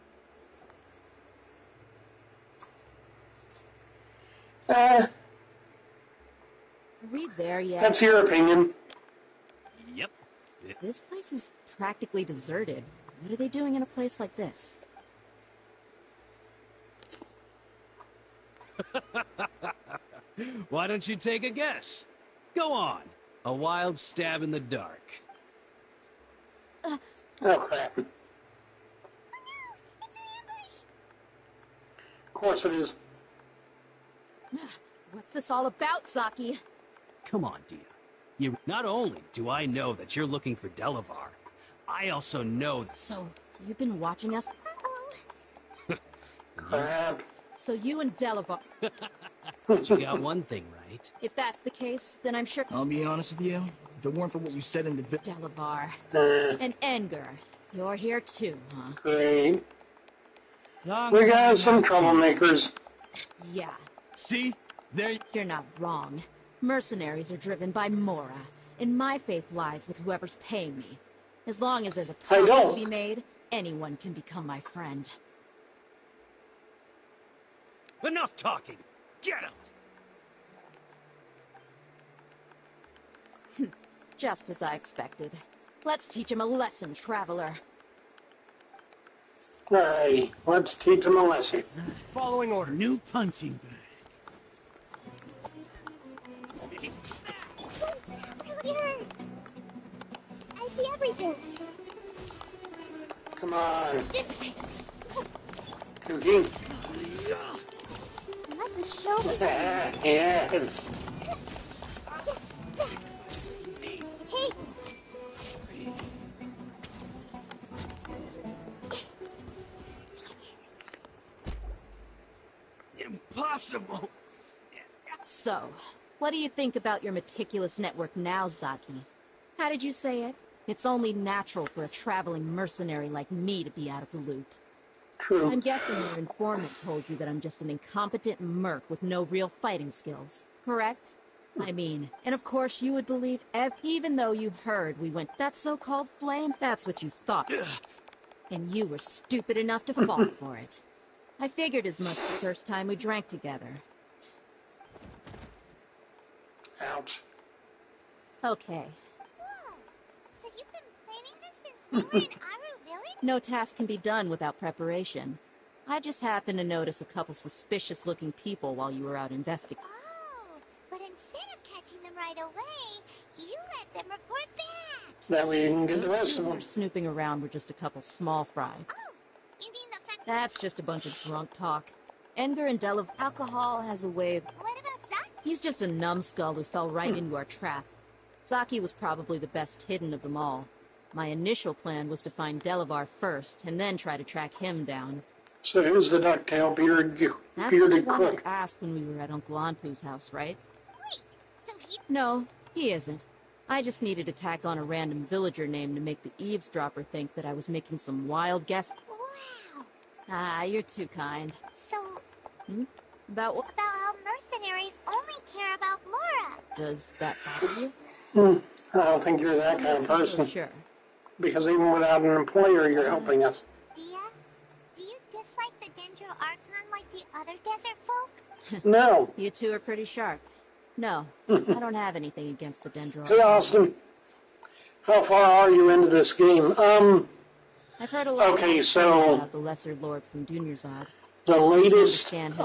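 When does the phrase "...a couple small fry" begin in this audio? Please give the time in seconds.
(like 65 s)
177 s.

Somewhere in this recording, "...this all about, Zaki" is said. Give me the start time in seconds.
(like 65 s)
35 s.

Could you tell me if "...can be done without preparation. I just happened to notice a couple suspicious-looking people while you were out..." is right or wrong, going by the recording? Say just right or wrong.
right.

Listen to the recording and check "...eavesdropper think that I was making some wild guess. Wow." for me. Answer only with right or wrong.
right.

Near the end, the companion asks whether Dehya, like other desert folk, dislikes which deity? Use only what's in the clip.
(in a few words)
Dendro Archon.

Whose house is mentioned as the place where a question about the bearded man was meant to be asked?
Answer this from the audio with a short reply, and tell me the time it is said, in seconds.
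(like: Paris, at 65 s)
Uncle Anpu, at 199 s.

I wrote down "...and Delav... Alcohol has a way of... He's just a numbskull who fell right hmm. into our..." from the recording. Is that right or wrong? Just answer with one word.
right.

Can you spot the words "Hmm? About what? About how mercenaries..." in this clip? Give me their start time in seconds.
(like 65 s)
212 s.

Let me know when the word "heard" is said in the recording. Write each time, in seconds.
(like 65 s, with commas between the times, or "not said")
144 s, 238 s.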